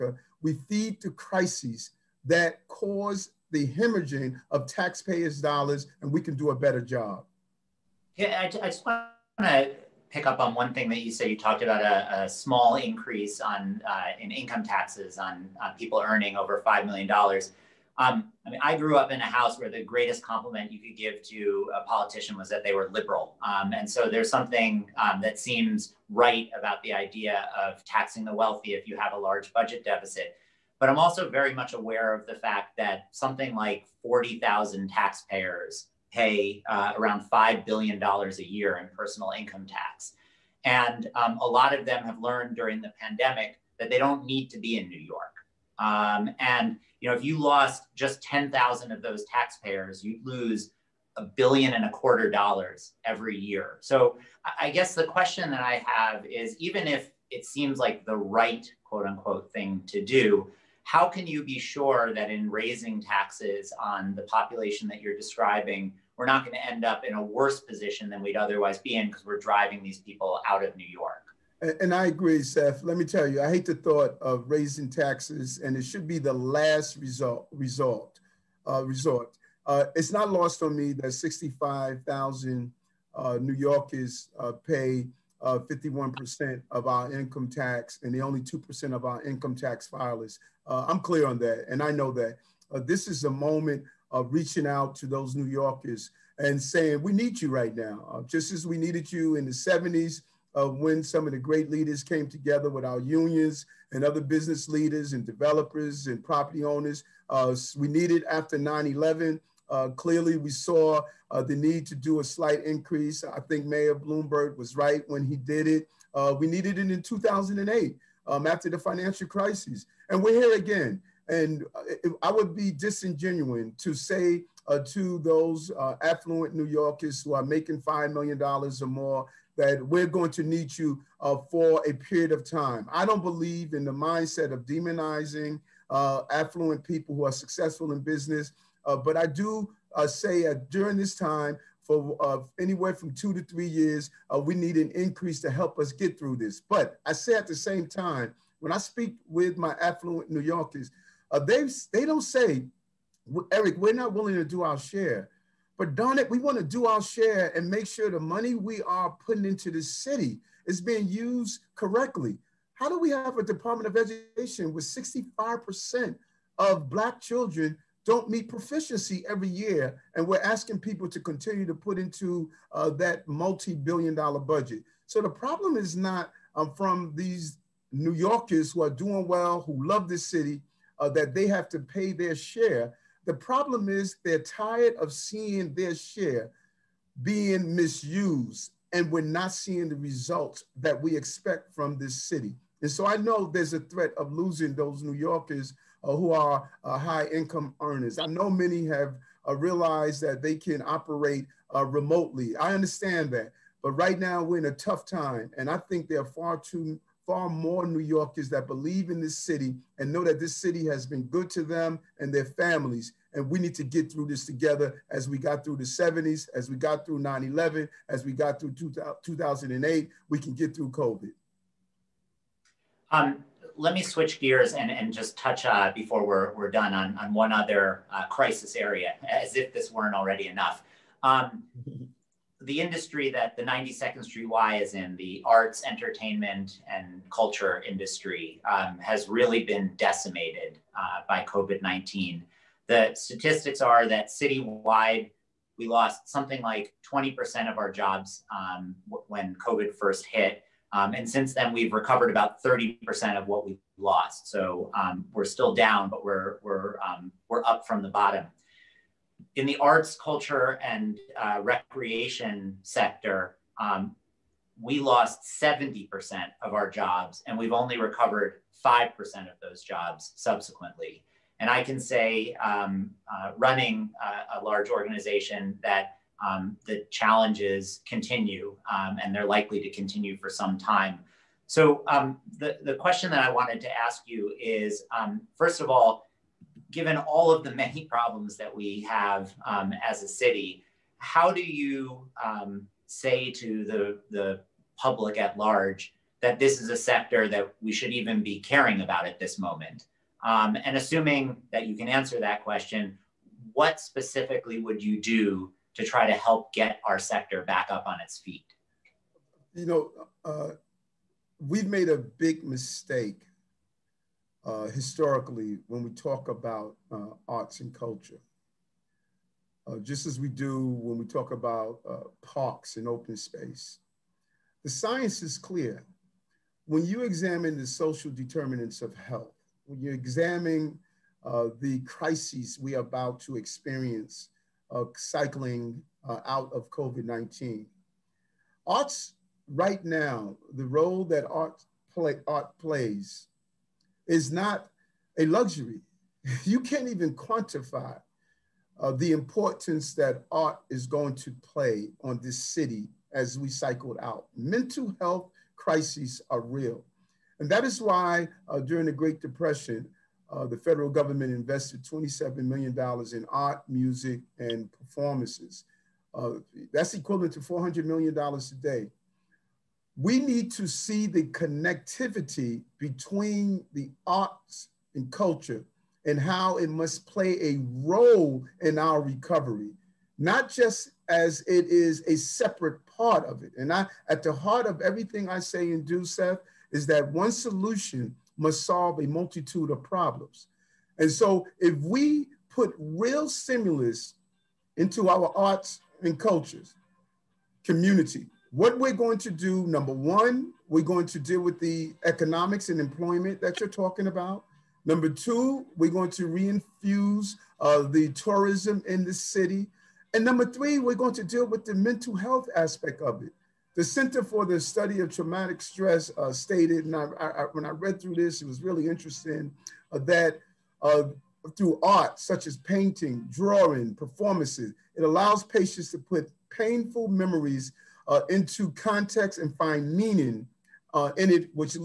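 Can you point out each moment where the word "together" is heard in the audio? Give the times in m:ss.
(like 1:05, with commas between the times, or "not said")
1:42, 3:34.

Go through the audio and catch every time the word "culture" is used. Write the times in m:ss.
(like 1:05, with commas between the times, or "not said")
3:57, 4:20, 5:17, 6:15, 6:36.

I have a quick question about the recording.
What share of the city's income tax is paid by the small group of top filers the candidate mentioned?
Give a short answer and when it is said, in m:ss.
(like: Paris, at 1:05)
51%, at 1:25.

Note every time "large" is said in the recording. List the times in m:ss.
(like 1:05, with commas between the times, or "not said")
0:29, 4:34, 4:55.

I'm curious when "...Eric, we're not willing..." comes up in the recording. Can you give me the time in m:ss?
2:33.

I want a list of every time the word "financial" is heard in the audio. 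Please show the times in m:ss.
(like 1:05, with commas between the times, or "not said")
1:58.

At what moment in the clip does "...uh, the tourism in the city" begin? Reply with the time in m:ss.
6:47.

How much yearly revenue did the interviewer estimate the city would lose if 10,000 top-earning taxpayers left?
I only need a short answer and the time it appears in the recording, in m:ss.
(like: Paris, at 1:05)
a billion and a quarter dollars, at 0:51.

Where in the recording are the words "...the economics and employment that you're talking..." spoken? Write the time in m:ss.
6:41.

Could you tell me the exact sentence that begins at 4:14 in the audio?
So um, we're still down, but we're, we're, um, we're up from the bottom.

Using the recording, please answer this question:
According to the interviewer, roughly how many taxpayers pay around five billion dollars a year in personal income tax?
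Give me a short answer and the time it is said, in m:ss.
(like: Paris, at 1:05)
40,000, at 0:34.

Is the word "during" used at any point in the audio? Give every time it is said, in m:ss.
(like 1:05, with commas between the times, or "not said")
0:42, 2:20, 5:58.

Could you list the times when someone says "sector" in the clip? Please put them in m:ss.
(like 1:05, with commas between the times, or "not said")
4:22, 4:56, 5:07.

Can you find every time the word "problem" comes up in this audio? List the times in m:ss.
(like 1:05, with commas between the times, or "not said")
2:55, 3:03, 4:48, 6:30.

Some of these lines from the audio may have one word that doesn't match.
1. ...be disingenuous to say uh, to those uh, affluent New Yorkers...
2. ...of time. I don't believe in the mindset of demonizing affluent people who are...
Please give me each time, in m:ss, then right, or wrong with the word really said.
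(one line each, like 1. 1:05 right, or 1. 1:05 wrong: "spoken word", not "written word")
1. 2:02 right
2. 2:12 right.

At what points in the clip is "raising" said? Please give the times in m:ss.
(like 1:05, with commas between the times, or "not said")
1:02, 1:14.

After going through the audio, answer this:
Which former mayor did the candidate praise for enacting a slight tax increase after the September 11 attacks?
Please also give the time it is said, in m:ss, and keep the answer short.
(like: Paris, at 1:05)
Mayor Bloomberg, at 1:53.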